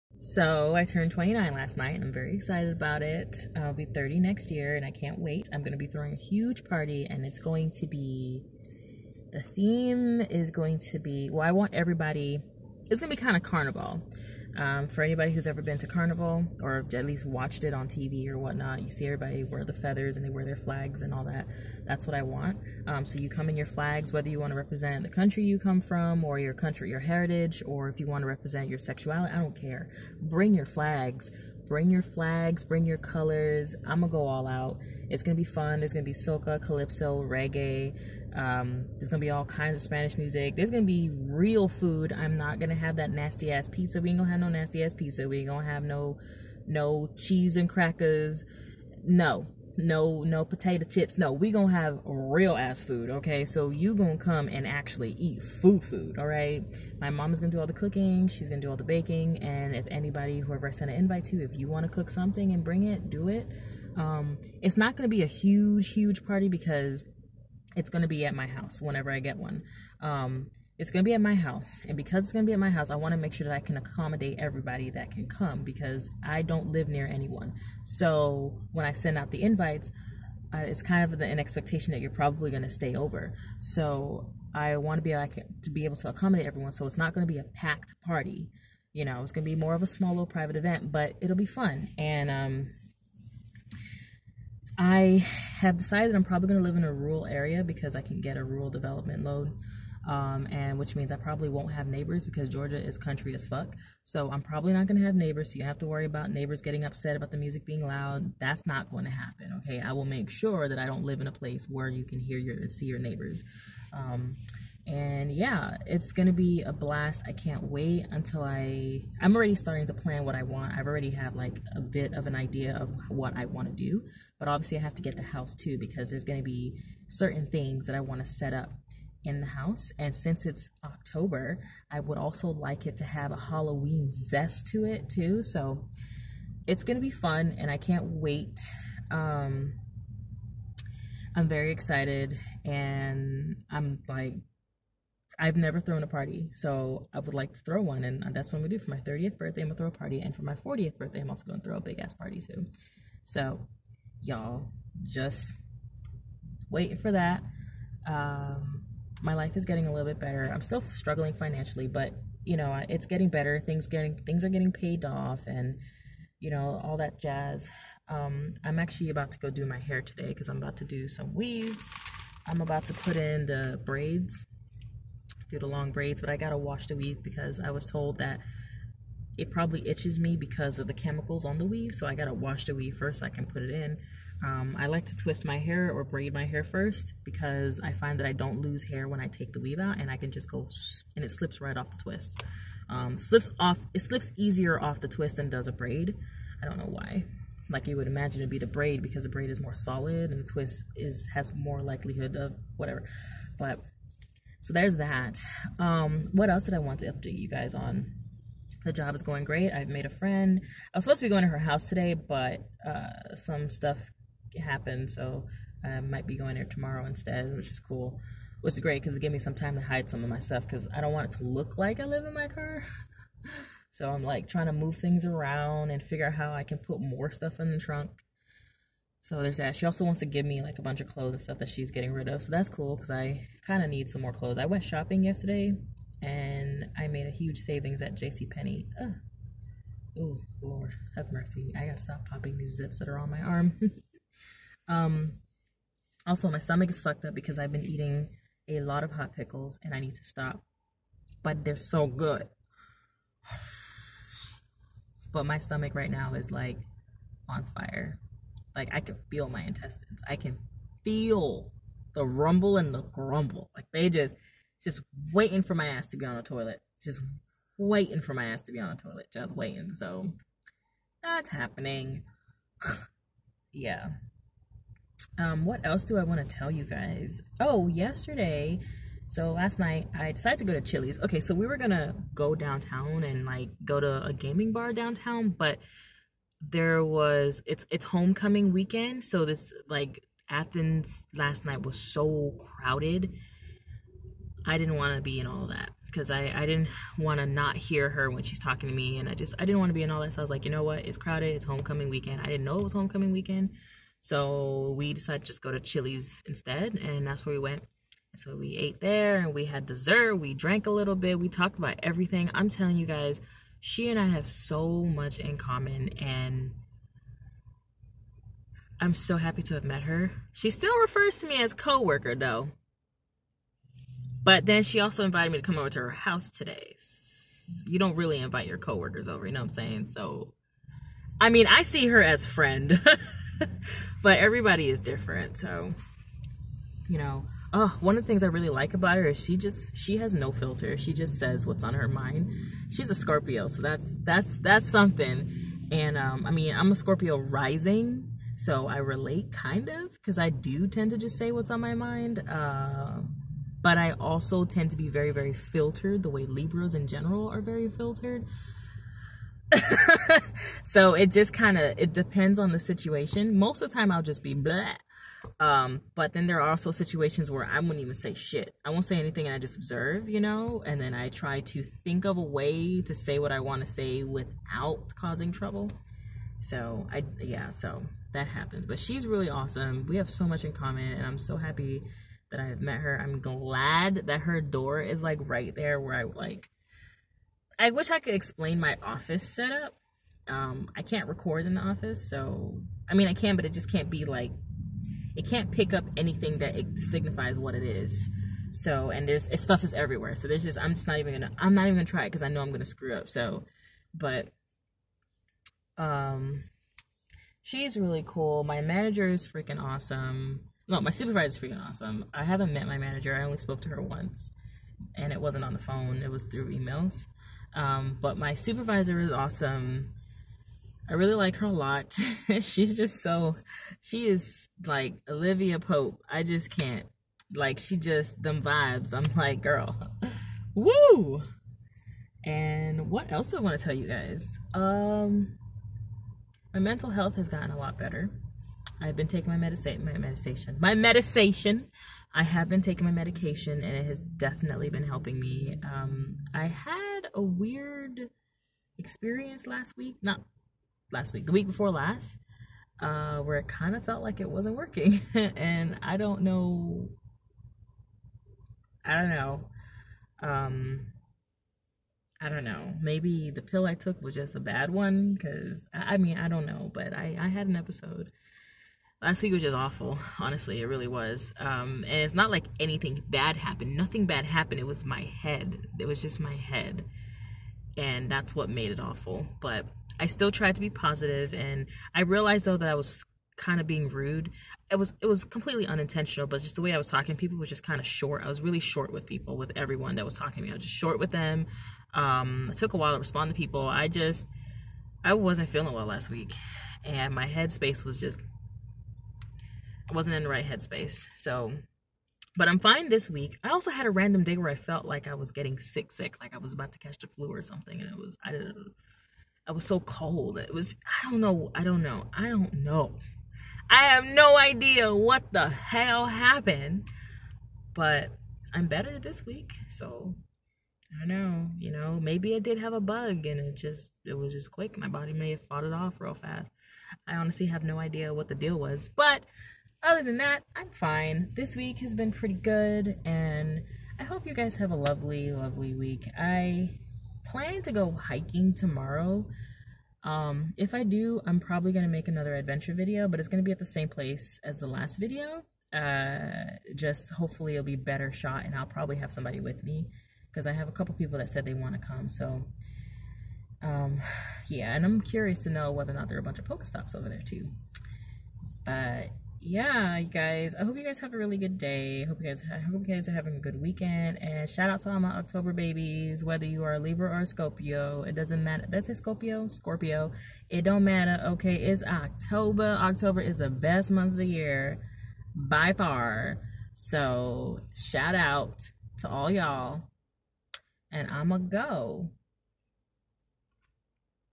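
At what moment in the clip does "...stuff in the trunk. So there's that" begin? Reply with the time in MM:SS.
03:47.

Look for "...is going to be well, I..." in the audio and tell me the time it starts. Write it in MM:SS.
00:10.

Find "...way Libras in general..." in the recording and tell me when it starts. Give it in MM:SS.
05:56.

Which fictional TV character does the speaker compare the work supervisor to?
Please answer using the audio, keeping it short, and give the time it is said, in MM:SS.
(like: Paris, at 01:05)
Olivia Pope, at 07:05.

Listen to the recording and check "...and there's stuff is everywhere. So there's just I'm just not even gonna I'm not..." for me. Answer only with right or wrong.
right.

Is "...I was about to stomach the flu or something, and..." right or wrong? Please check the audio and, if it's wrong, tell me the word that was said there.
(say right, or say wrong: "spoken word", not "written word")
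wrong: "catch", not "stomach".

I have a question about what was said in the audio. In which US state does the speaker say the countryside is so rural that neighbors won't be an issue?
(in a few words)
Georgia.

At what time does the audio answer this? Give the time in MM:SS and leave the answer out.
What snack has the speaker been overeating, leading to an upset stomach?
04:09.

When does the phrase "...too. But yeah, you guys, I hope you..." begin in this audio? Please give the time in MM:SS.
09:17.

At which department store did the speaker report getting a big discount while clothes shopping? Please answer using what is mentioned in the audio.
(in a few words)
JCPenney.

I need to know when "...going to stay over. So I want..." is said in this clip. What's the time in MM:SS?
01:22.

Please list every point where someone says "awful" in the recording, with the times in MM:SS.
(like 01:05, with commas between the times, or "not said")
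07:49, 07:58.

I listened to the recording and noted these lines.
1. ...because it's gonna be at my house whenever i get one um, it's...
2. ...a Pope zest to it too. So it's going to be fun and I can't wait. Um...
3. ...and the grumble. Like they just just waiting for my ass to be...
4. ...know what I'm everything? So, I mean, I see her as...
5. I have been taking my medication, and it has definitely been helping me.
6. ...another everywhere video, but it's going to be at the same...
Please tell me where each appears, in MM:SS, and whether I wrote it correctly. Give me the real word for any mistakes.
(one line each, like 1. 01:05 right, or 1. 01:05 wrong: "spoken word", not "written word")
1. 01:06 right
2. 02:13 wrong: "Halloween", not "Pope"
3. 04:22 right
4. 05:29 wrong: "saying", not "everything"
5. 07:22 right
6. 09:02 wrong: "adventure", not "everywhere".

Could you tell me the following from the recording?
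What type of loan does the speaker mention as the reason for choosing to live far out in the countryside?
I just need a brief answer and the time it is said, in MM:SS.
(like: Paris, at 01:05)
Rural development loan, at 01:38.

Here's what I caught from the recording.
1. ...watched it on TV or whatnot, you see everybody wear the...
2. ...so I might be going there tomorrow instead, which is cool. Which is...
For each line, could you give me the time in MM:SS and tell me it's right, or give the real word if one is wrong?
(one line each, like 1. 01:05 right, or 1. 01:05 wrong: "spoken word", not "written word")
1. 00:17 right
2. 03:35 right.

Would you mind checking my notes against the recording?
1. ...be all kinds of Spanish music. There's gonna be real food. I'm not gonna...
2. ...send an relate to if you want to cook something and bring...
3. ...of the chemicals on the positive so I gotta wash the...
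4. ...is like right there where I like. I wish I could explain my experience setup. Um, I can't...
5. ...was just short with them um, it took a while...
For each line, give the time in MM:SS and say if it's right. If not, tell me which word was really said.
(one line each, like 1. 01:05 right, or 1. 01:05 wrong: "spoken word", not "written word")
1. 00:39 right
2. 01:00 wrong: "invite", not "relate"
3. 03:00 wrong: "weave", not "positive"
4. 06:25 wrong: "office", not "experience"
5. 08:10 right.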